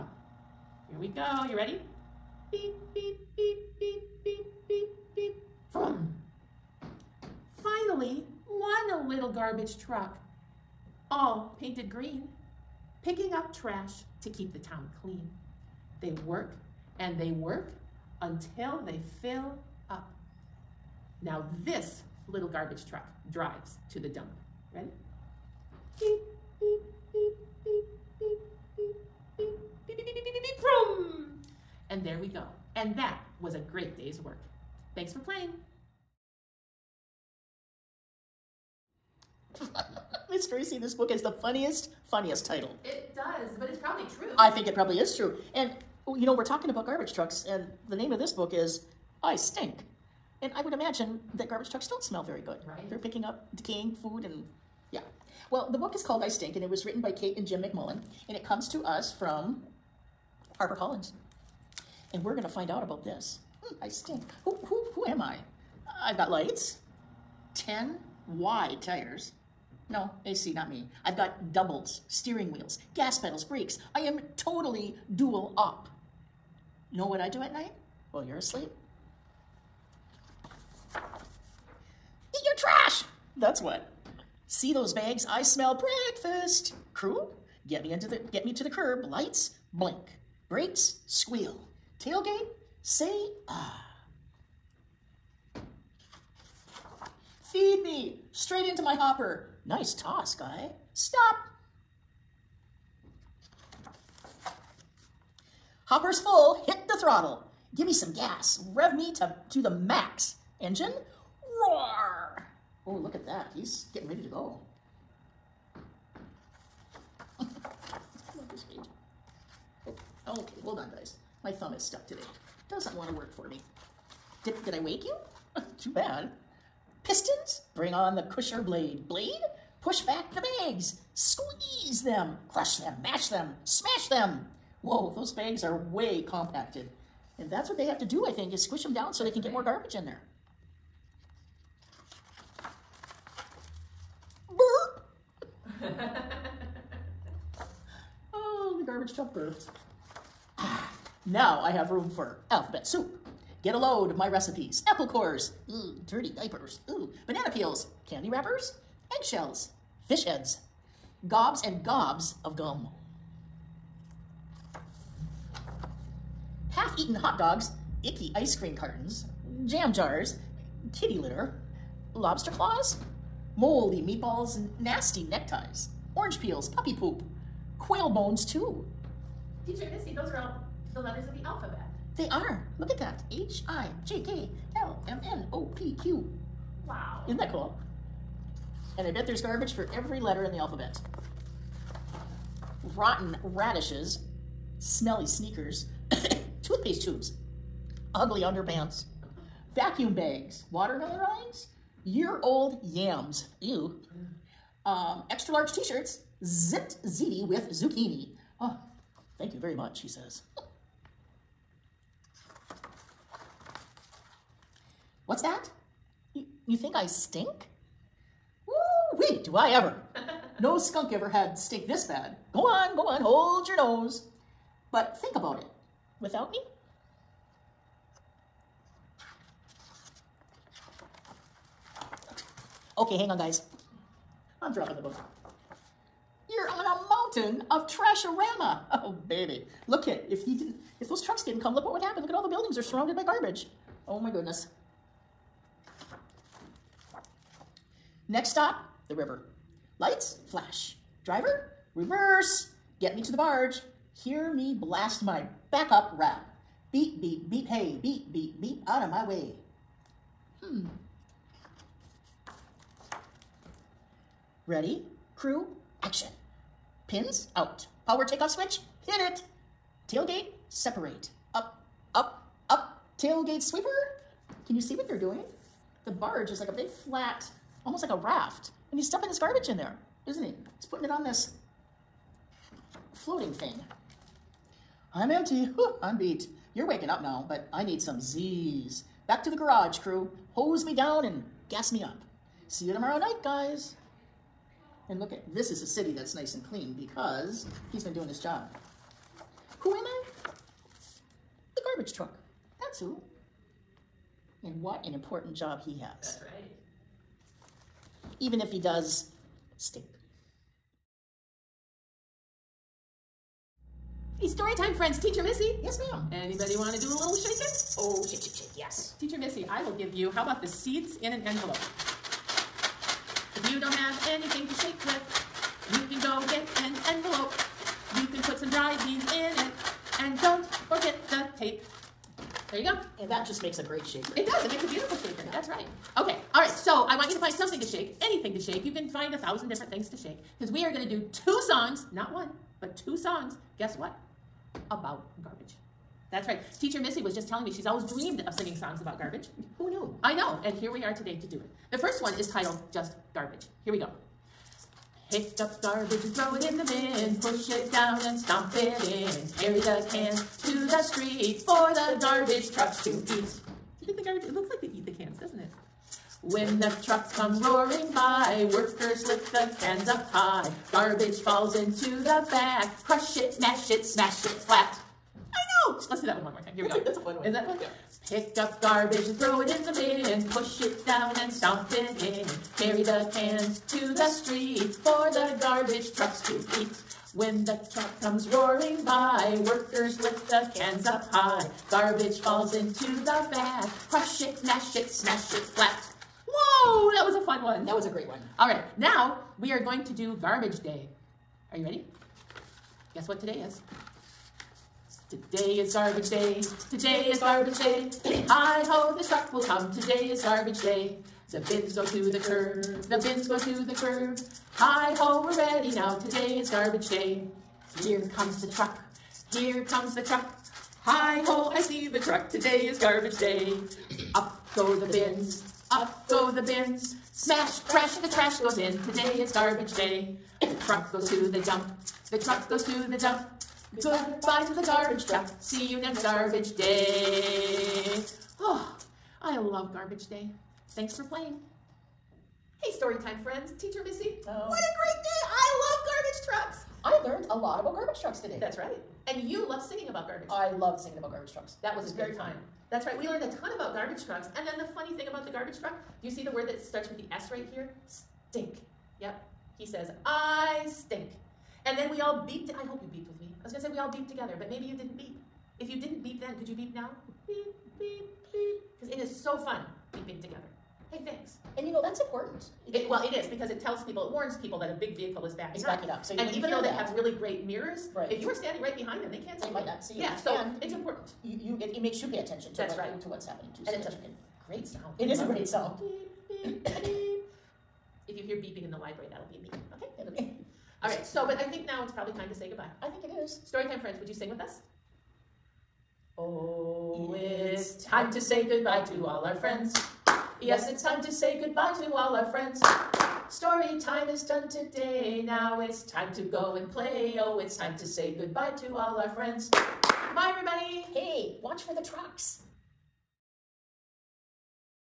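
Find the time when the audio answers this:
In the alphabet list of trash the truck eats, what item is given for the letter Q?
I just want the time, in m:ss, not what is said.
2:57.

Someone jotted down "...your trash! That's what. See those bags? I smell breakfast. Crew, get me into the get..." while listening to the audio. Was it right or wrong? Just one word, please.
right.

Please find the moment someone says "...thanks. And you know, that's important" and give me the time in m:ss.
7:51.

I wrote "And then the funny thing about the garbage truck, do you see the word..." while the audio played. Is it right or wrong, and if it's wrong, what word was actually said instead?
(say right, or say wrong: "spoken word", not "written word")
right.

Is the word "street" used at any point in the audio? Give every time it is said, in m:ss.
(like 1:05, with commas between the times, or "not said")
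6:01, 6:24.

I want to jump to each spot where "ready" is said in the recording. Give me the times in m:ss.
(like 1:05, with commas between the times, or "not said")
0:01, 0:24, 1:54, 4:24, 6:41, 6:55.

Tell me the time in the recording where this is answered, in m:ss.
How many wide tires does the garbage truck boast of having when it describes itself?
1:07.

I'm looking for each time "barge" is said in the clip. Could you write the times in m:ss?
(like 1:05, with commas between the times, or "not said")
4:13, 4:36.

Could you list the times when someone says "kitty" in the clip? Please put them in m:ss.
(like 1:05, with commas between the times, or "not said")
2:50.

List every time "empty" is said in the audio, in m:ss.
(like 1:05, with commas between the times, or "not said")
4:45.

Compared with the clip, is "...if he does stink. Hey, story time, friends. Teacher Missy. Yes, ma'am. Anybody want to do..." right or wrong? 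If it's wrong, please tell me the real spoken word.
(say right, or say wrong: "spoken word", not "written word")
right.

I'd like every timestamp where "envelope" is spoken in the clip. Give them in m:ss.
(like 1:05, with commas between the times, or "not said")
5:21, 5:27.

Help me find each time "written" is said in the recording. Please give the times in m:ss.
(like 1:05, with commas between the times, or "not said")
0:56.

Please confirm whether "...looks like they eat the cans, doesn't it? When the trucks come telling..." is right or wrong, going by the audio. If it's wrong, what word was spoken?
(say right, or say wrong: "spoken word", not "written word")
wrong: "roaring", not "telling".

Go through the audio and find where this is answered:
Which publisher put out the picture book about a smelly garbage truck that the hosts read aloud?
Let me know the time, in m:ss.
1:00.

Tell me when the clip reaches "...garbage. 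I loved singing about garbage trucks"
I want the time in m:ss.
7:30.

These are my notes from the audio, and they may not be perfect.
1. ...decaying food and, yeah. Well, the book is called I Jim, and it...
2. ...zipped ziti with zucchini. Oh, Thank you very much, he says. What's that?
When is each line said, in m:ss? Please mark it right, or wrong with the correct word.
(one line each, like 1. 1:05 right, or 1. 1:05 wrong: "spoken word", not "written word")
1. 0:53 wrong: "Stink", not "Jim"
2. 3:26 right.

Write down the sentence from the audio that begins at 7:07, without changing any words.
Smash, crash, the trash goes in.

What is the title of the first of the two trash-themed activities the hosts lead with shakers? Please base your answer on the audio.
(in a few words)
Just Garbage.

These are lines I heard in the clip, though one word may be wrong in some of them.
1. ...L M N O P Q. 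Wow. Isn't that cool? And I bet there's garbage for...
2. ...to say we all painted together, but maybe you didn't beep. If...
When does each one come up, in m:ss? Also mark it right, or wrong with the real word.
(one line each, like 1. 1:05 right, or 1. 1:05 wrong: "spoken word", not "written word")
1. 3:04 right
2. 7:43 wrong: "beeped", not "painted".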